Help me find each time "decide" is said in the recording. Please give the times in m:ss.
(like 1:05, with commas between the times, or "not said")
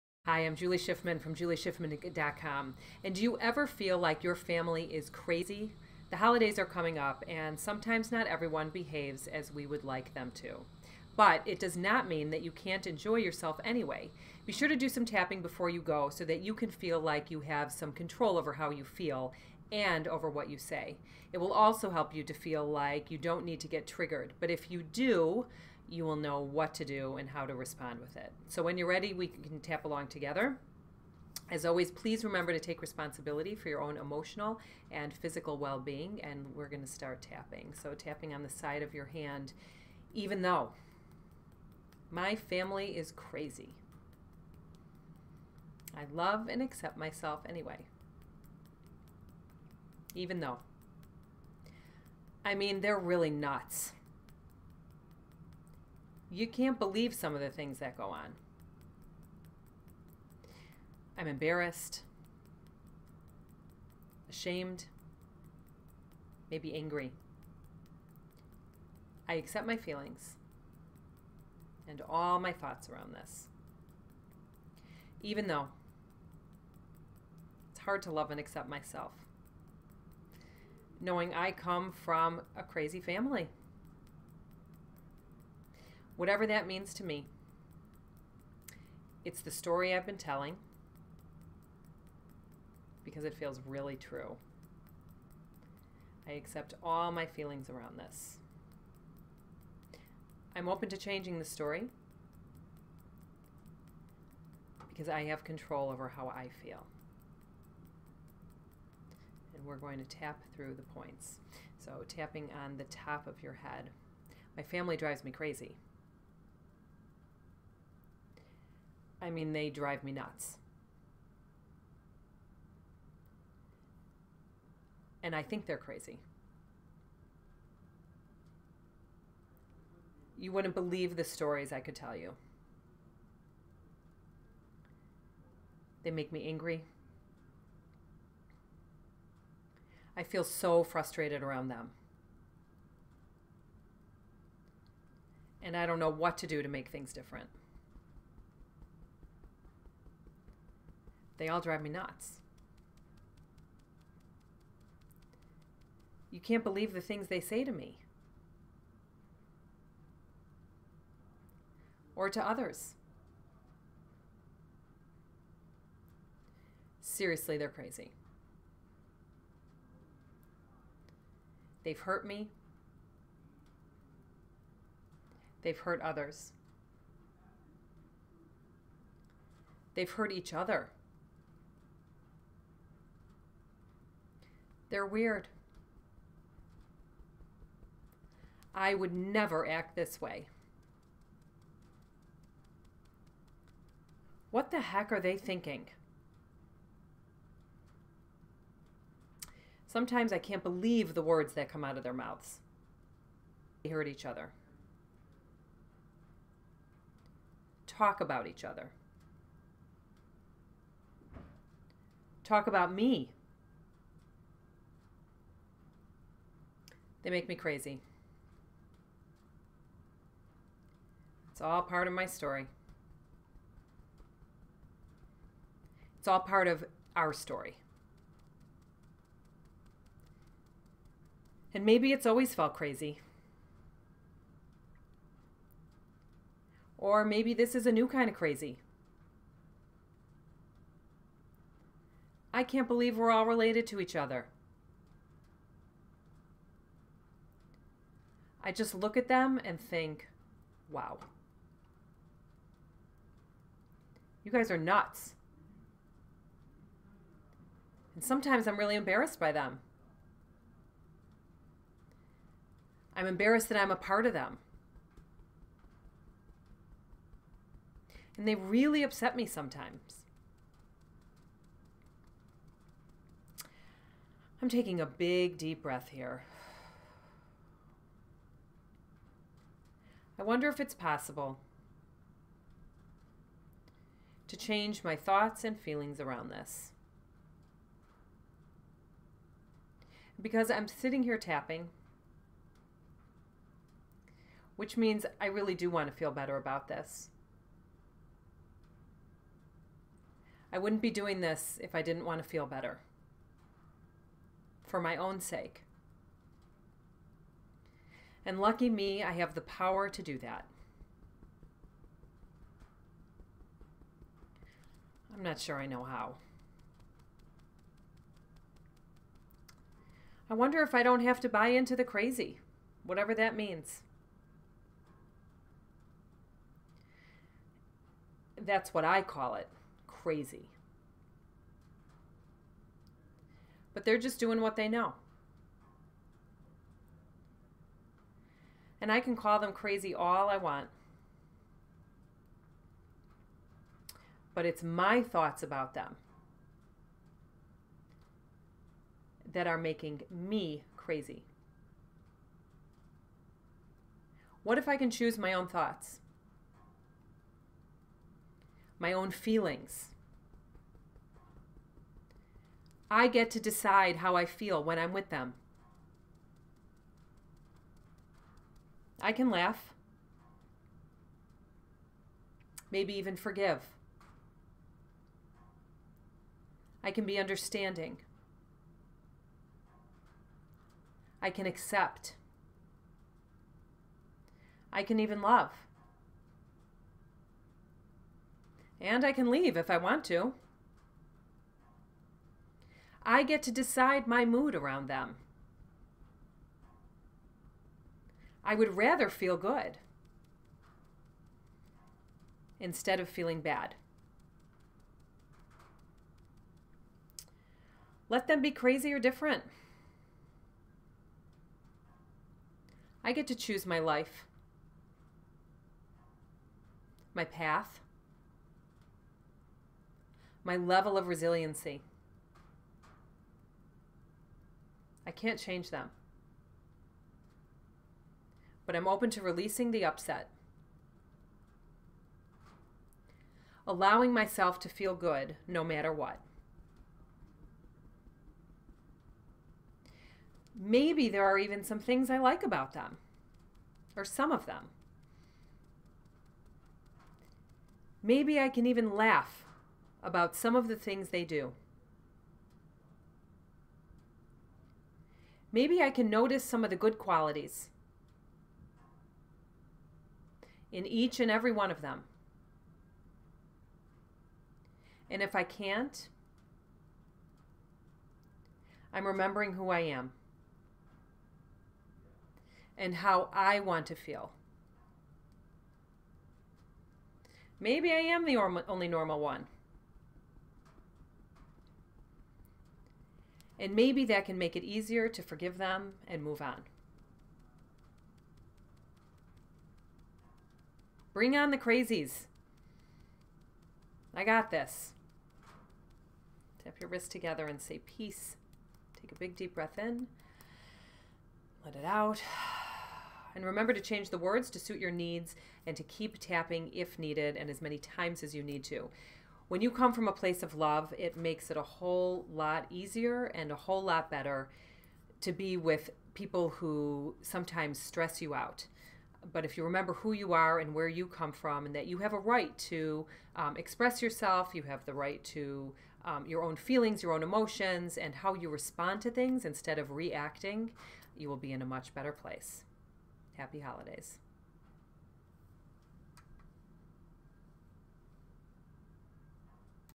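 6:03, 6:33.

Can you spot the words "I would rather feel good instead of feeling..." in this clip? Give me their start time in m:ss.
6:38.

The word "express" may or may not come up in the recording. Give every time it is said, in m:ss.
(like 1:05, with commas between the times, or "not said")
8:43.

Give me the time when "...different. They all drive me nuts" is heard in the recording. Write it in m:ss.
2:27.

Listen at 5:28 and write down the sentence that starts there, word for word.
That's what I call it crazy.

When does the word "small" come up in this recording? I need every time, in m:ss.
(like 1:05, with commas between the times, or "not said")
not said.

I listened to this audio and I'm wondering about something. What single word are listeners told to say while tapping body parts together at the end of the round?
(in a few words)
peace.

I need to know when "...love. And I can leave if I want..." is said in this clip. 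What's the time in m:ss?
6:25.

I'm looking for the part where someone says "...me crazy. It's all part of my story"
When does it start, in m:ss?
3:37.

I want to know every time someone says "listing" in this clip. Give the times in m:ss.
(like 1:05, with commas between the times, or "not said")
not said.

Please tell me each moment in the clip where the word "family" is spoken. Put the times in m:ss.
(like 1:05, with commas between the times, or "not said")
0:04, 0:42, 1:23, 1:54.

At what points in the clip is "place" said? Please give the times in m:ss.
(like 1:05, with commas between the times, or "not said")
8:30, 8:52.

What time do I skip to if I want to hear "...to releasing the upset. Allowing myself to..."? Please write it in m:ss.
7:09.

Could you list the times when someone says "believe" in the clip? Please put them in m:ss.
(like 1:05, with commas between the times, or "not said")
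0:56, 2:10, 2:36, 3:20, 4:02.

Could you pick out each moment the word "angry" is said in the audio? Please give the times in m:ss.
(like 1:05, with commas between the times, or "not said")
1:06, 2:16.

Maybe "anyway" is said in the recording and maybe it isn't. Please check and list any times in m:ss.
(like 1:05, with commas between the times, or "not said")
0:13, 0:47.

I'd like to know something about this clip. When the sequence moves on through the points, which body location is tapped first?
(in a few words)
top of your head.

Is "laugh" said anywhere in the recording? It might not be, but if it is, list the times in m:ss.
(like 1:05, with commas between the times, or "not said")
6:09, 7:29.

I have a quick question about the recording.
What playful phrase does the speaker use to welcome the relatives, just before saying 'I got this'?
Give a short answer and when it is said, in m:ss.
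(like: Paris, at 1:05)
Bring on the crazies, at 8:11.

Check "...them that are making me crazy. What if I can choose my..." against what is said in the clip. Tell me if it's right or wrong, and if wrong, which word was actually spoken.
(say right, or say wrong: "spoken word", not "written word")
right.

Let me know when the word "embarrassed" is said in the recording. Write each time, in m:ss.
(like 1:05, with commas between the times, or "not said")
1:01, 4:18, 4:23.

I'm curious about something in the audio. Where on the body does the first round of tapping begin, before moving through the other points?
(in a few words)
side of your hand.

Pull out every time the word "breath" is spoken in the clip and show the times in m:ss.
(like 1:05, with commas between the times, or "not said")
4:35, 8:19.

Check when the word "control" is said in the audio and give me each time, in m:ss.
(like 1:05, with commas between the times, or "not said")
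0:17, 1:45.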